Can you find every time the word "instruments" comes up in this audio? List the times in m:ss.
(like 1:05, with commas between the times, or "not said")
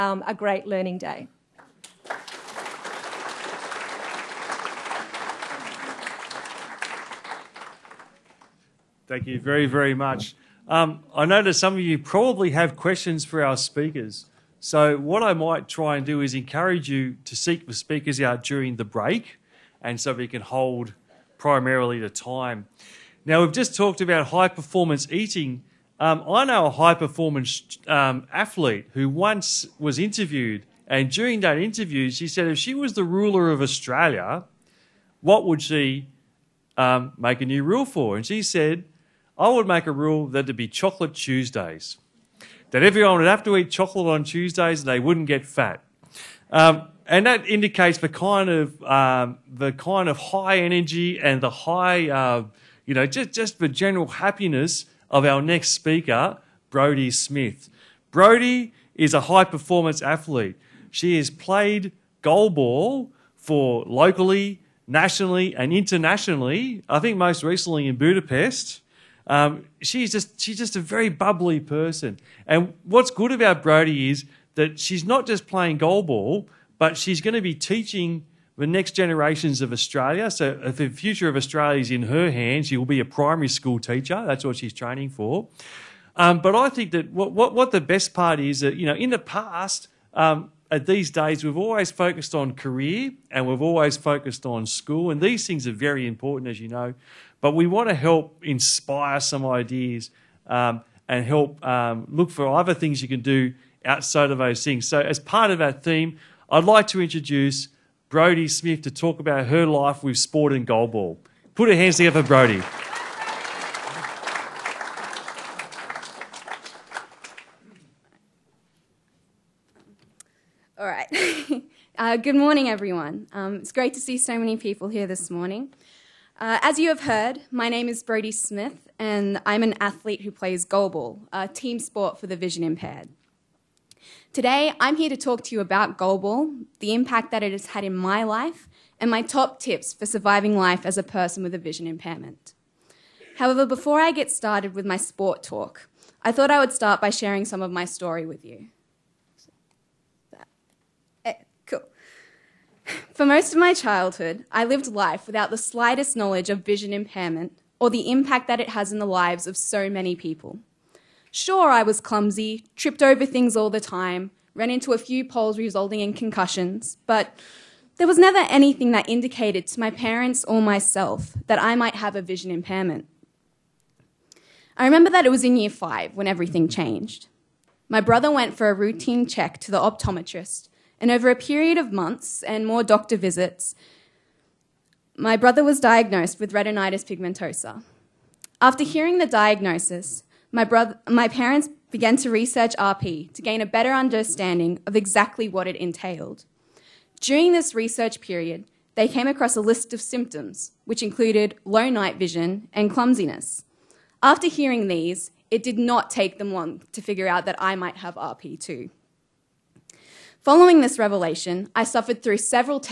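not said.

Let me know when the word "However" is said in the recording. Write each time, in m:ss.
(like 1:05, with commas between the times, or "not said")
2:23.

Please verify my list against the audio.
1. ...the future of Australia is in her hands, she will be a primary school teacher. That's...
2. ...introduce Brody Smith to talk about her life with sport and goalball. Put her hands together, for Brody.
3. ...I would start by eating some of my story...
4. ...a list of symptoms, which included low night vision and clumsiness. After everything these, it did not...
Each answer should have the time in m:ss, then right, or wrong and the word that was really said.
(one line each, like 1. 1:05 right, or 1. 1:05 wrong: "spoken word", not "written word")
1. 1:20 right
2. 1:47 right
3. 2:26 wrong: "sharing", not "eating"
4. 3:19 wrong: "hearing", not "everything".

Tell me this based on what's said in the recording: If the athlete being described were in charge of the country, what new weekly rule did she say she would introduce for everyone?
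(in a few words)
Chocolate Tuesdays.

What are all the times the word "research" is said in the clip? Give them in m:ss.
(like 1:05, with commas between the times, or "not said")
3:12, 3:17.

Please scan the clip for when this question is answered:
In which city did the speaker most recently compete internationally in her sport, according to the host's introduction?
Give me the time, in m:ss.
1:07.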